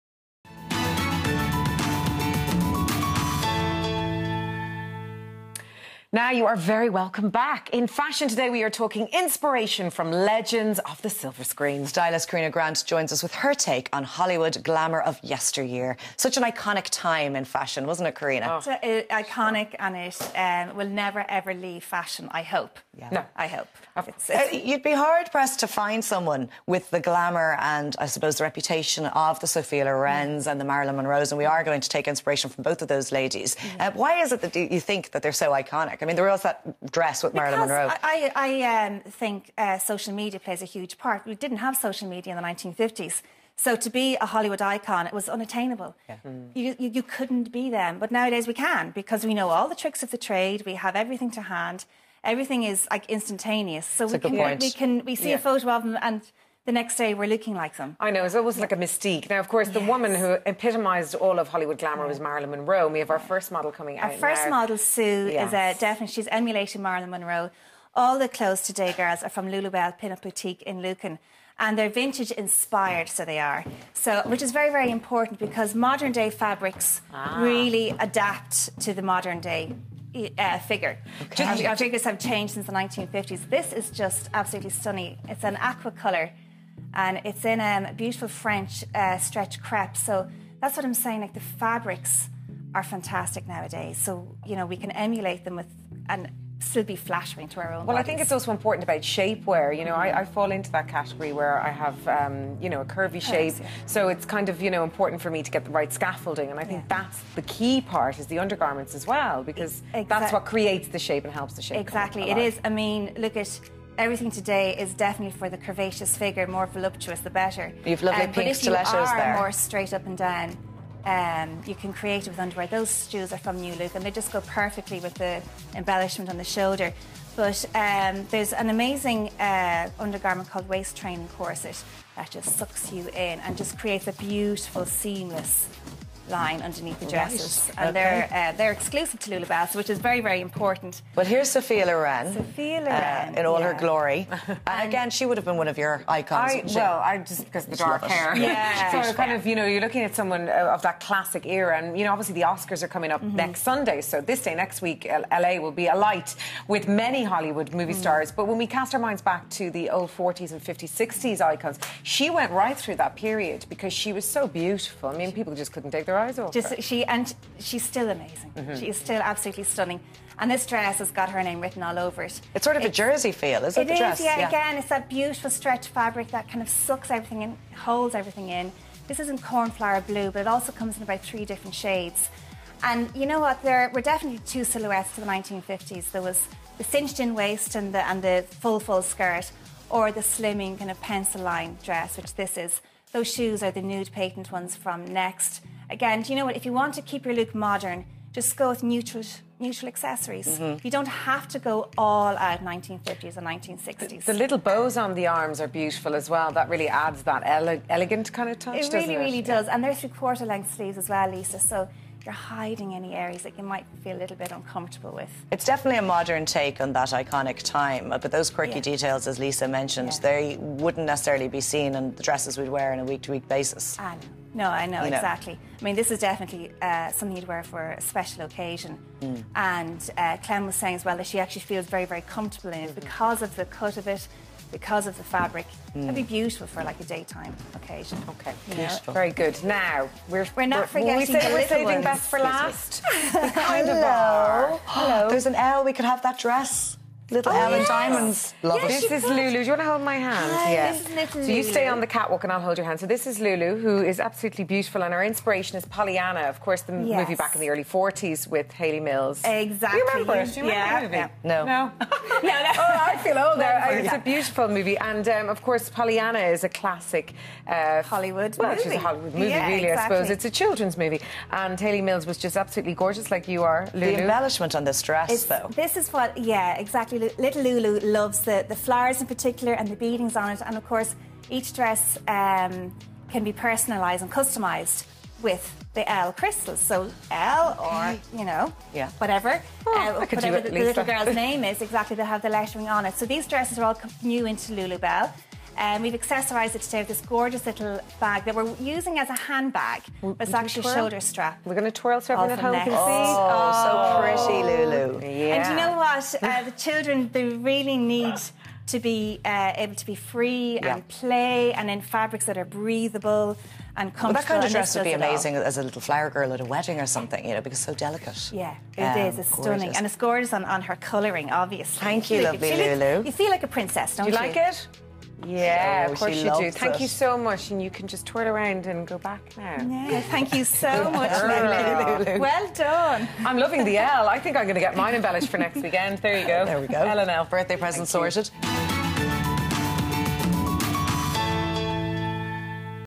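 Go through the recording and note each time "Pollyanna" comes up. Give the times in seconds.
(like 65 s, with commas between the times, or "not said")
255 s, 265 s.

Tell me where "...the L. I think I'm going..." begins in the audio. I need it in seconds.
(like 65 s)
333 s.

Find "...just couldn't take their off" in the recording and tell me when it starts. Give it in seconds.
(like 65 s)
165 s.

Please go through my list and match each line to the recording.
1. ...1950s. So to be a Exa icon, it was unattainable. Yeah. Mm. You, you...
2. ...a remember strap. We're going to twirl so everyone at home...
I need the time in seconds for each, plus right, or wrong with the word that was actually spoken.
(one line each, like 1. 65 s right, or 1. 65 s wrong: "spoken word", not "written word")
1. 42 s wrong: "Hollywood", not "Exa"
2. 300 s wrong: "shoulder", not "remember".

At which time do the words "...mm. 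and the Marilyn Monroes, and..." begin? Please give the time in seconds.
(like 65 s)
30 s.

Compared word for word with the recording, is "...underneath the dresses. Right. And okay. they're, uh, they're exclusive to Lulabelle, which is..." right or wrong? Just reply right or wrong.
right.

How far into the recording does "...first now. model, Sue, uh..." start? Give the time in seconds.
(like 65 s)
64 s.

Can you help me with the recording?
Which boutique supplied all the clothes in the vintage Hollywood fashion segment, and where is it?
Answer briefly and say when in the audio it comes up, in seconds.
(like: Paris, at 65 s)
Lulubelle Pinup Boutique in Lucan, at 69 s.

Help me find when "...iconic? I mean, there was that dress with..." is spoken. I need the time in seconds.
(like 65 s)
35 s.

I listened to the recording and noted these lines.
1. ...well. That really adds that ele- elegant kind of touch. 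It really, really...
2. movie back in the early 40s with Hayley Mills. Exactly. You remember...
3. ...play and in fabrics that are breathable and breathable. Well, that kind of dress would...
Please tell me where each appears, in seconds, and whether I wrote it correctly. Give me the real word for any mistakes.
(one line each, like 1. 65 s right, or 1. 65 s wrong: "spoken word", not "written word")
1. 206 s right
2. 257 s right
3. 311 s wrong: "comfortable", not "breathable".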